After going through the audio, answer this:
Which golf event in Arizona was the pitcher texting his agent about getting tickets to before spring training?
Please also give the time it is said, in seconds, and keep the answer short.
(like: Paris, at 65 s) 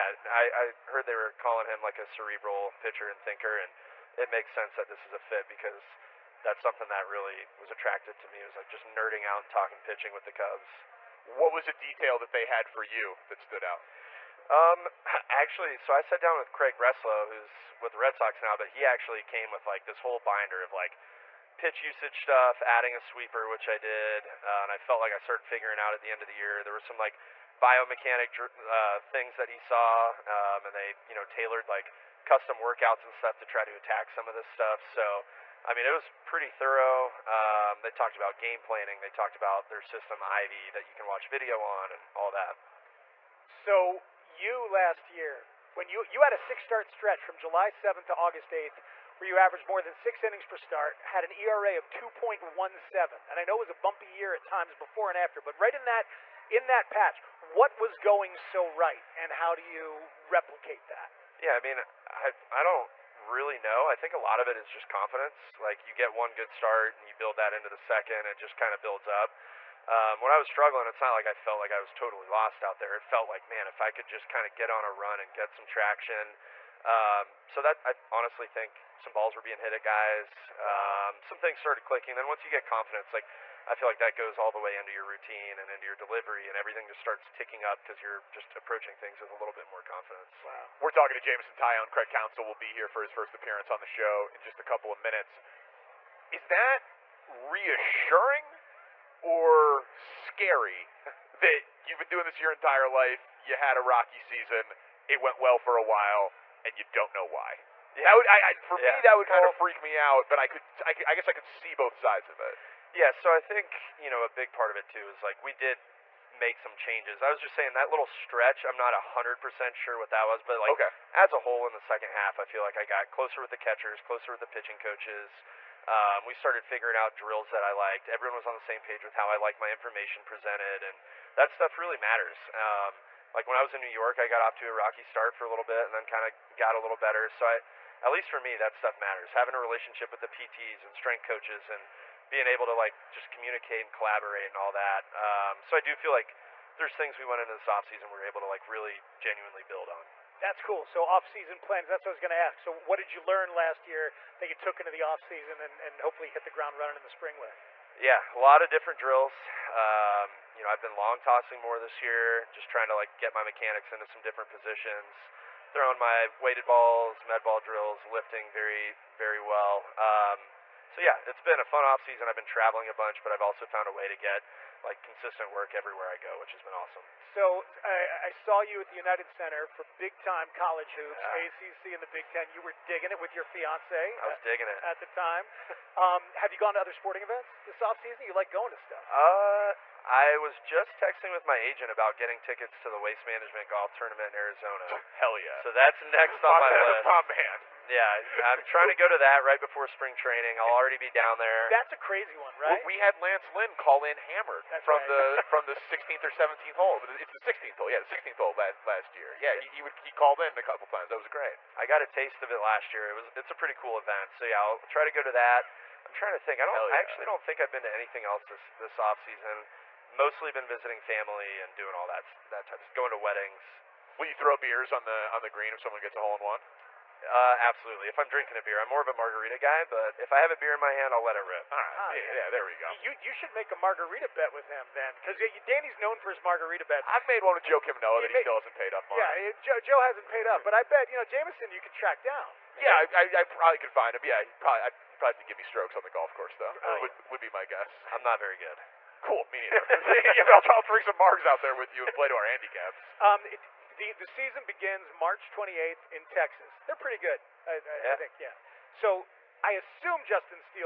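Waste Management Golf Tournament, at 192 s.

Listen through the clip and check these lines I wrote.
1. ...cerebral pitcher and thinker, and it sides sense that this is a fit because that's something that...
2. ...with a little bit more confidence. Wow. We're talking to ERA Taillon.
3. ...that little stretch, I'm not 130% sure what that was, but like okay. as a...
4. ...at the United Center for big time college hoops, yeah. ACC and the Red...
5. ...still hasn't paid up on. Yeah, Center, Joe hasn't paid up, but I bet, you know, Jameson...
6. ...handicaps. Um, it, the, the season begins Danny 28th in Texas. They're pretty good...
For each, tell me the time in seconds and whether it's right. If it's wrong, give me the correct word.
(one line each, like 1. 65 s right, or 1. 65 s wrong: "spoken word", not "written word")
1. 2 s wrong: "makes", not "sides"
2. 89 s wrong: "Jameson", not "ERA"
3. 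117 s wrong: "100", not "130"
4. 178 s wrong: "Big", not "Red"
5. 238 s wrong: "Joe", not "Center"
6. 252 s wrong: "March", not "Danny".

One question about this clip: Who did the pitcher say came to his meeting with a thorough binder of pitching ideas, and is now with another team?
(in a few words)
Craig Breslow.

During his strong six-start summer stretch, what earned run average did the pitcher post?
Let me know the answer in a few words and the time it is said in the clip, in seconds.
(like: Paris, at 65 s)
2.17, at 51 s.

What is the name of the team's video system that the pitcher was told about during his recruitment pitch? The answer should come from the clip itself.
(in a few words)
Ivy.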